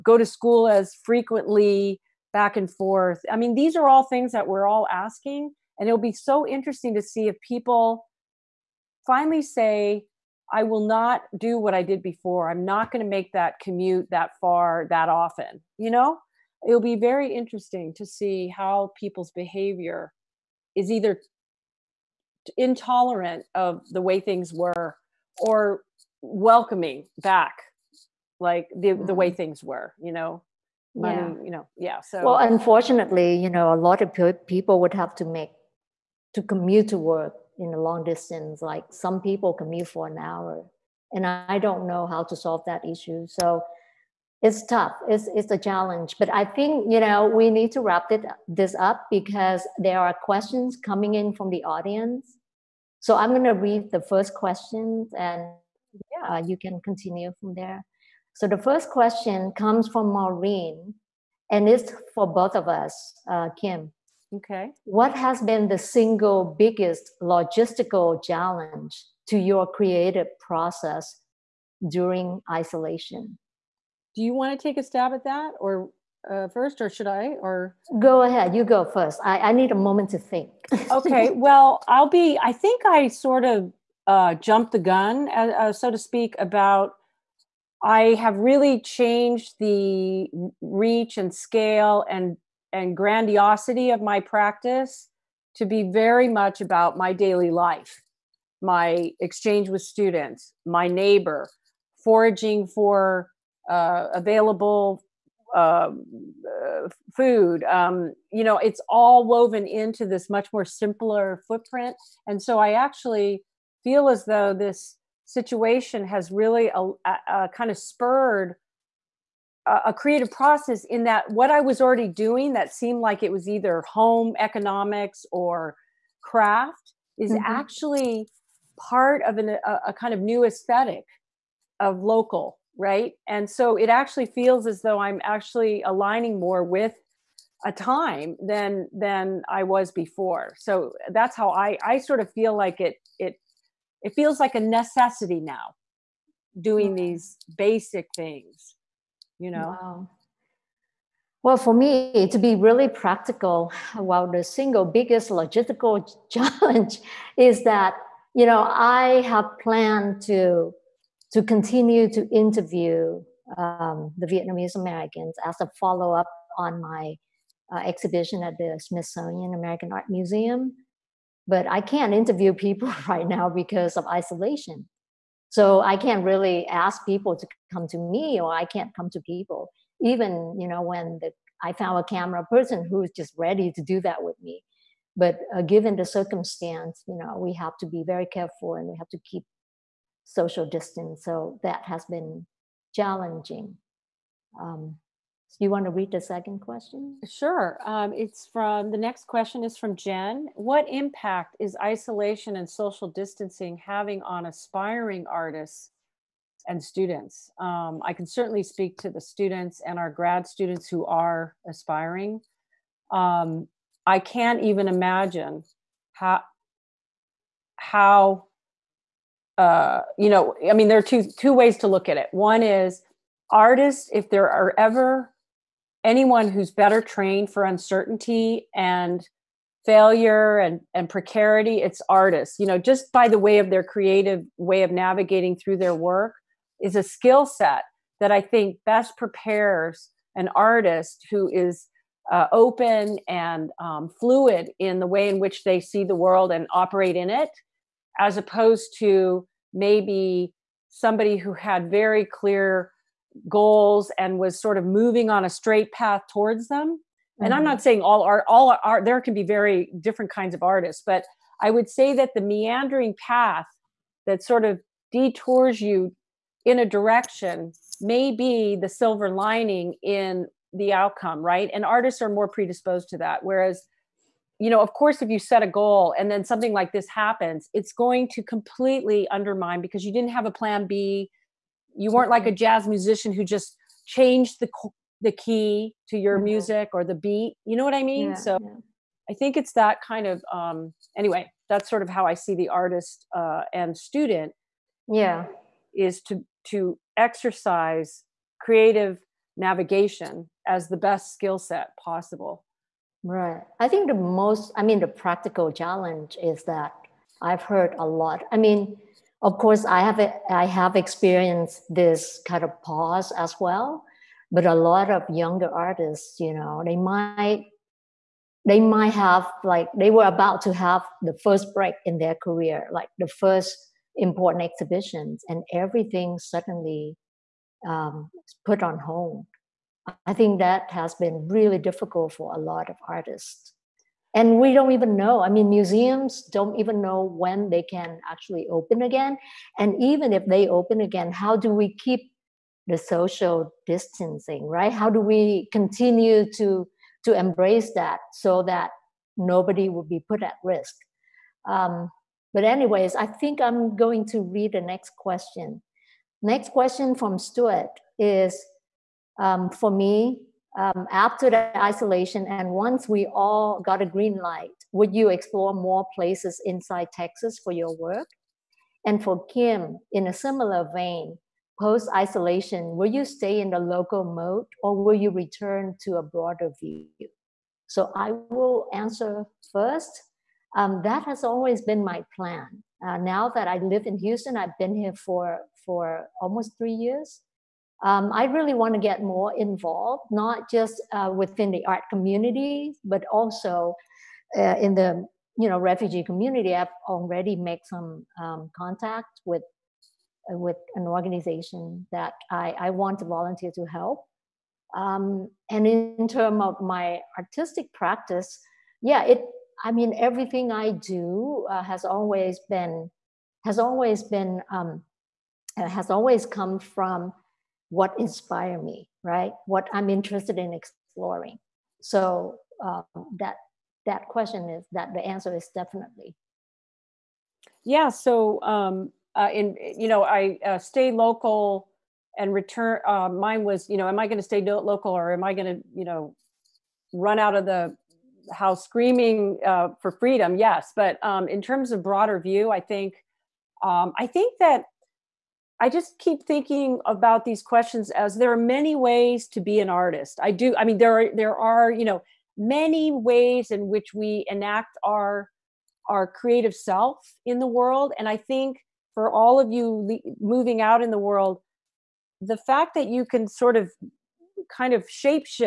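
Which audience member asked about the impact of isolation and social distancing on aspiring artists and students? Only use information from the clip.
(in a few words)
Jen.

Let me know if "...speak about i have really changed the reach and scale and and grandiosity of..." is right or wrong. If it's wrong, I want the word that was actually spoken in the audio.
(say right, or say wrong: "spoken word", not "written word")
right.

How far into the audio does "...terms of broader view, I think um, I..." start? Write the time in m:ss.
7:21.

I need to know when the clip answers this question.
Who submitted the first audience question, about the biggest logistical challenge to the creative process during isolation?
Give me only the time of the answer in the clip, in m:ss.
1:00.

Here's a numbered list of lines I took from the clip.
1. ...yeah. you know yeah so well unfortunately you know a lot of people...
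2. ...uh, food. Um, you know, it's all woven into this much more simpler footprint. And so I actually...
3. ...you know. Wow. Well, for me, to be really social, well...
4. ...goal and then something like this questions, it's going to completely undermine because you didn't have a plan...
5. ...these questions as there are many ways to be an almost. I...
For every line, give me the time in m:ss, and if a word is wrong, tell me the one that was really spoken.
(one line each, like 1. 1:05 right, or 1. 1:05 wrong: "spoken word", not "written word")
1. 0:31 right
2. 1:46 right
3. 2:29 wrong: "practical", not "social"
4. 4:35 wrong: "happens", not "questions"
5. 7:27 wrong: "artist", not "almost".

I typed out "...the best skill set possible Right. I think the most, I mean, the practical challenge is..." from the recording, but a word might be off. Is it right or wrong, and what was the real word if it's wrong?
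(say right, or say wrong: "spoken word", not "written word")
right.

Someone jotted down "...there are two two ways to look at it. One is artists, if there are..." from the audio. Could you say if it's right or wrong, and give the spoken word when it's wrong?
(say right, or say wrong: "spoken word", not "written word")
right.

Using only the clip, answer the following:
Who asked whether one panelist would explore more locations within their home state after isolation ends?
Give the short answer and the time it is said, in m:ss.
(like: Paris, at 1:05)
Stuart, at 5:57.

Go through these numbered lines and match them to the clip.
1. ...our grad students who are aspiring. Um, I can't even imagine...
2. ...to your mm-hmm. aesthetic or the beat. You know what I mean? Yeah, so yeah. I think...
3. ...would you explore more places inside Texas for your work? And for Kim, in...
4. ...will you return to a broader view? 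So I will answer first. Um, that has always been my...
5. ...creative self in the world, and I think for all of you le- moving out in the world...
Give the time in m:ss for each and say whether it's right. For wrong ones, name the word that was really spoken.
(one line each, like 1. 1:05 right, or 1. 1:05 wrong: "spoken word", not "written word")
1. 3:29 right
2. 4:46 wrong: "music", not "aesthetic"
3. 6:04 right
4. 6:15 right
5. 7:36 right.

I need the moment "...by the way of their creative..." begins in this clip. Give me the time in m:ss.
3:53.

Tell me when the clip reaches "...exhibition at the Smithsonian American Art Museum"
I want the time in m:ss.
2:47.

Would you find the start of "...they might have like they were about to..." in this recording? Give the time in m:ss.
5:18.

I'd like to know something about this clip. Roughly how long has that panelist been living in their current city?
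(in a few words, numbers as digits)
Almost 3 years.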